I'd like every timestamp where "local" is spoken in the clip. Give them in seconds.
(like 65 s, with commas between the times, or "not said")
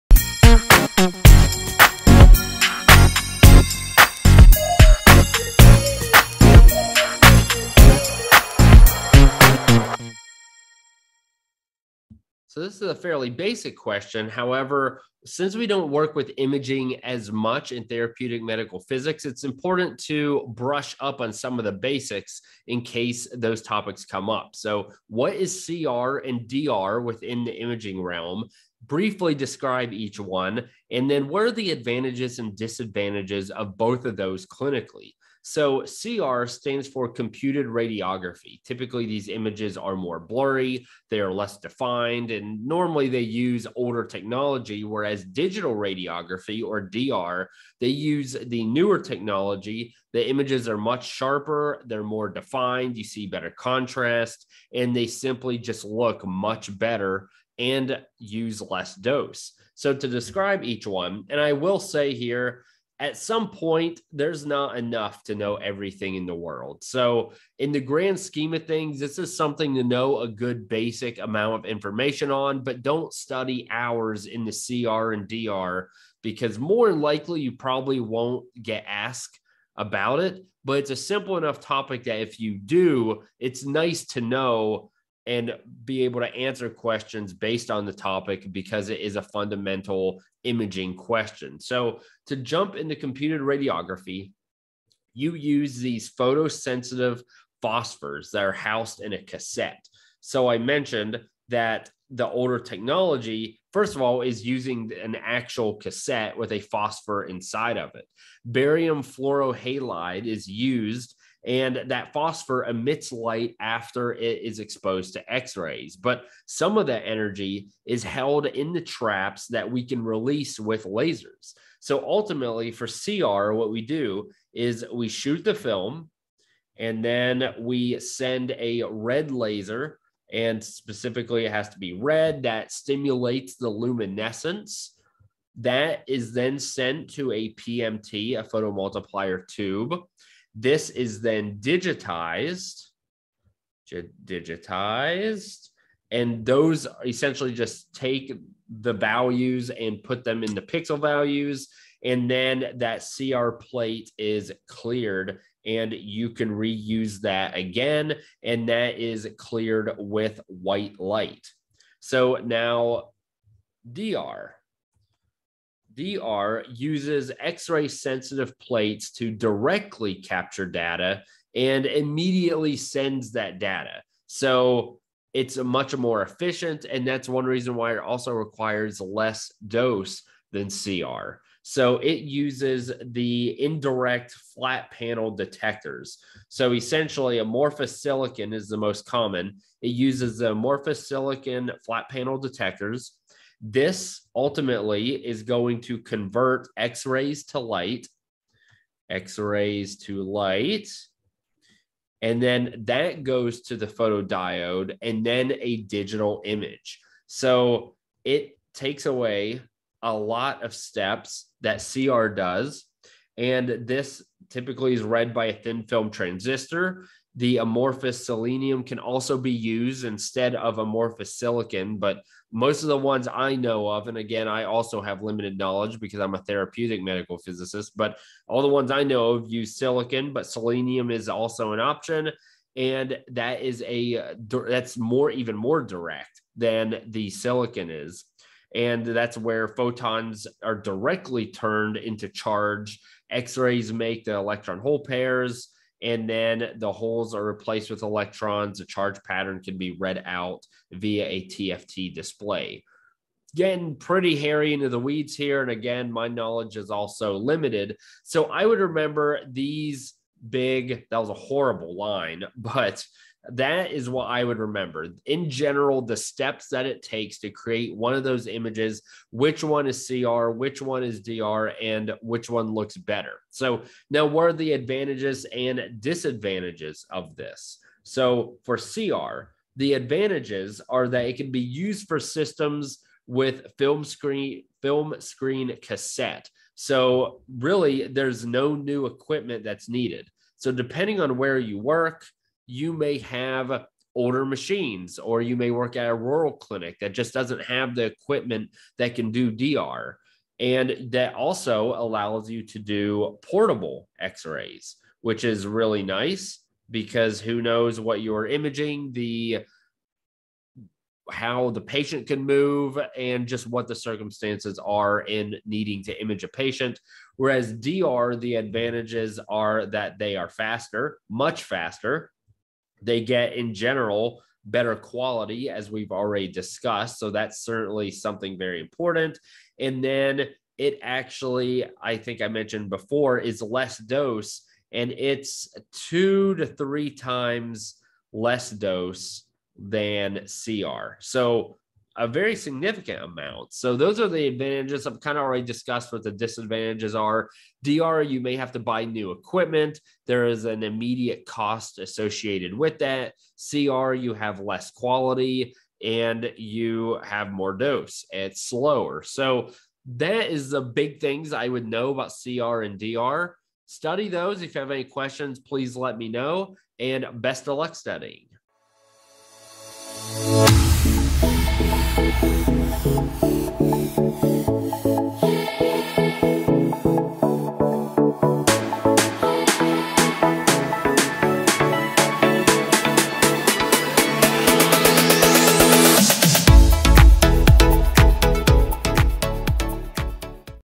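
not said.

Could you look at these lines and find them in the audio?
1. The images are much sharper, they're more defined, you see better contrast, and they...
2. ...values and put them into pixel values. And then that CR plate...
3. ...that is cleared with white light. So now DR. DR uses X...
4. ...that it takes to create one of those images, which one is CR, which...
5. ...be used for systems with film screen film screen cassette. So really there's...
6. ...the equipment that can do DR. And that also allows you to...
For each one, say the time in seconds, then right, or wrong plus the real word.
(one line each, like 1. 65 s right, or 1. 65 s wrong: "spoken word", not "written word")
1. 50 s right
2. 148 s right
3. 158 s right
4. 266 s right
5. 281 s right
6. 297 s right.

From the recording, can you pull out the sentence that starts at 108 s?
Barium fluorohalide is used and that phosphor emits light after it is exposed to X rays.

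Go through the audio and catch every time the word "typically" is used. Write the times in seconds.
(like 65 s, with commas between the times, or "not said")
38 s, 214 s.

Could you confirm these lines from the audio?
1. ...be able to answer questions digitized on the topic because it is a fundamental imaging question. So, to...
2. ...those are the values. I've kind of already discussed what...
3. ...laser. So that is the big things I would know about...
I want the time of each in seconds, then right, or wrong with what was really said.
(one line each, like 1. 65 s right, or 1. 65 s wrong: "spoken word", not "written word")
1. 85 s wrong: "based", not "digitized"
2. 343 s wrong: "advantages", not "values"
3. 358 s wrong: "slower", not "laser".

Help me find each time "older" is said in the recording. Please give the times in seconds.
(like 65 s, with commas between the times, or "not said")
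43 s, 102 s, 294 s.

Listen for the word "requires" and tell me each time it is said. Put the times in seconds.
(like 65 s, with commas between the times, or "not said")
178 s.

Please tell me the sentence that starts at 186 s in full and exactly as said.
So essentially, amorphous silicon is the most common.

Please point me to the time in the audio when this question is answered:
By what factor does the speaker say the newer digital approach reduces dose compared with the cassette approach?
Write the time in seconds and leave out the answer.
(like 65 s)
335 s.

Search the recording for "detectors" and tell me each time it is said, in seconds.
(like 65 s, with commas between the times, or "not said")
185 s, 192 s.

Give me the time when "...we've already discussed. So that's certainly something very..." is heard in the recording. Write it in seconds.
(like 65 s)
325 s.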